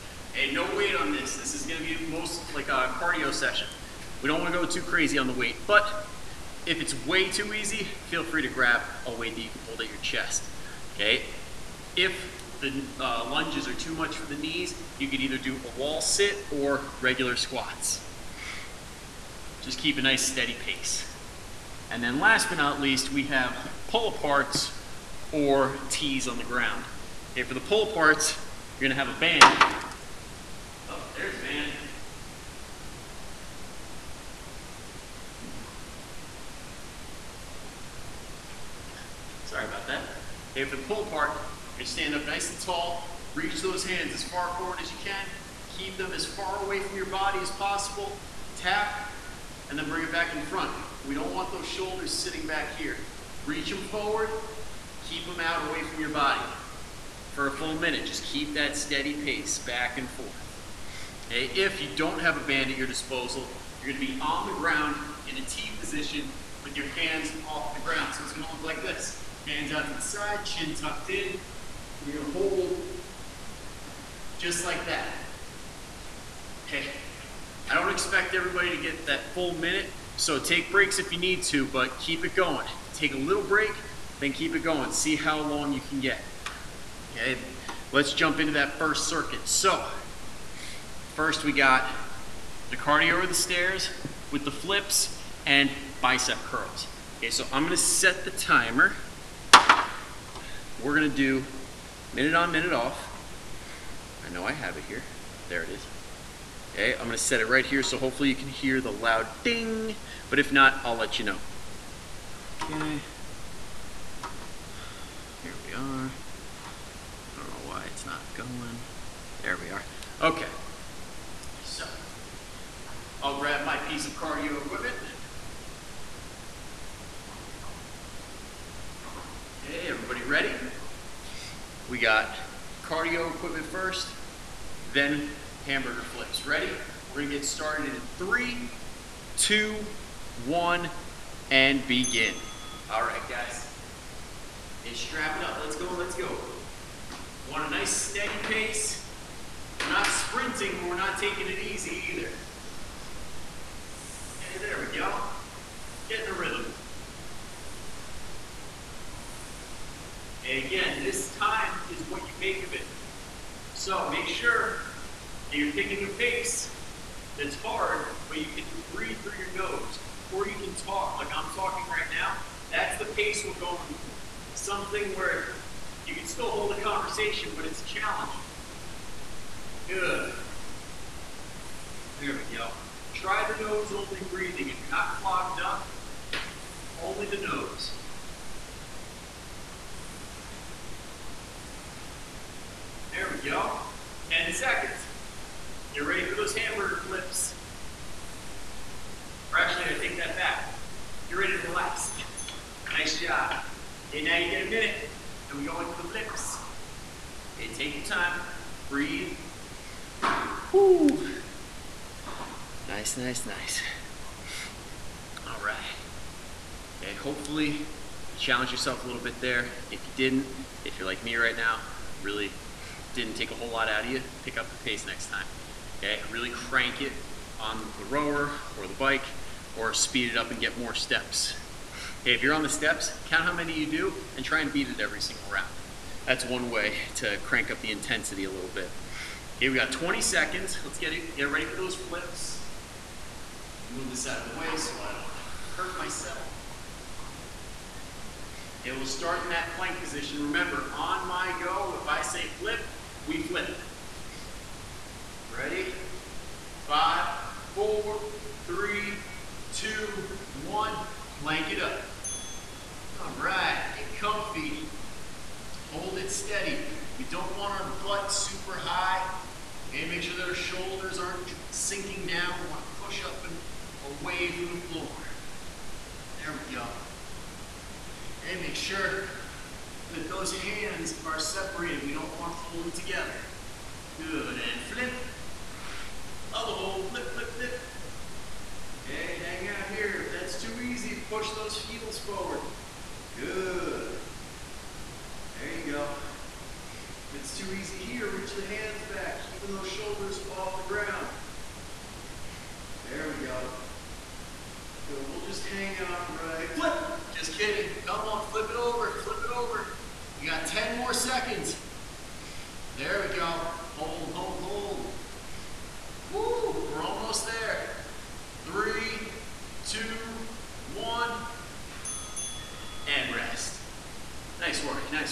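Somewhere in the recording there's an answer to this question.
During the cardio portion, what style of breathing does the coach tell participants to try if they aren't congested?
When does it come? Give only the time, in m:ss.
3:03.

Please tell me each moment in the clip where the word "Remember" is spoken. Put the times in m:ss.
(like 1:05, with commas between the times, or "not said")
4:10.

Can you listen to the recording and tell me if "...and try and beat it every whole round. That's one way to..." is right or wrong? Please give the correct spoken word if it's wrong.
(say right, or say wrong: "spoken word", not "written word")
wrong: "single", not "whole".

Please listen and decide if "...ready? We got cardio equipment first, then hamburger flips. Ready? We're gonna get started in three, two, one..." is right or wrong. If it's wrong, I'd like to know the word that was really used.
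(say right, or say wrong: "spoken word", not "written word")
right.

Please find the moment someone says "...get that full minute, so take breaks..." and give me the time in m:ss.
1:18.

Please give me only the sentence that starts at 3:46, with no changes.
Okay, really crank it on the rower or the bike or speed it up and get more steps.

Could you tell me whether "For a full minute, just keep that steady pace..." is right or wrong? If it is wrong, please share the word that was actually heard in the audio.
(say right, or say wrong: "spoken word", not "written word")
right.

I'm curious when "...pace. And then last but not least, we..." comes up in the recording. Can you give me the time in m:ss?
0:20.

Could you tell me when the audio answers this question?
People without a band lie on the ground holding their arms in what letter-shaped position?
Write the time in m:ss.
1:05.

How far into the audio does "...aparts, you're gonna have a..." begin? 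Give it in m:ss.
0:27.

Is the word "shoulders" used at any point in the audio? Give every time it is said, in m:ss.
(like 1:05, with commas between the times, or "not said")
0:51, 4:30, 4:59.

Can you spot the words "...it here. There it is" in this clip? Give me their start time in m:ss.
1:44.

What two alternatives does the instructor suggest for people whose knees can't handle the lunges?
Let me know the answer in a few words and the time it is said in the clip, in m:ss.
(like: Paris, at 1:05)
Wall sit or regular squats, at 0:15.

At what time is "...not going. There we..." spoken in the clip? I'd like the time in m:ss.
1:58.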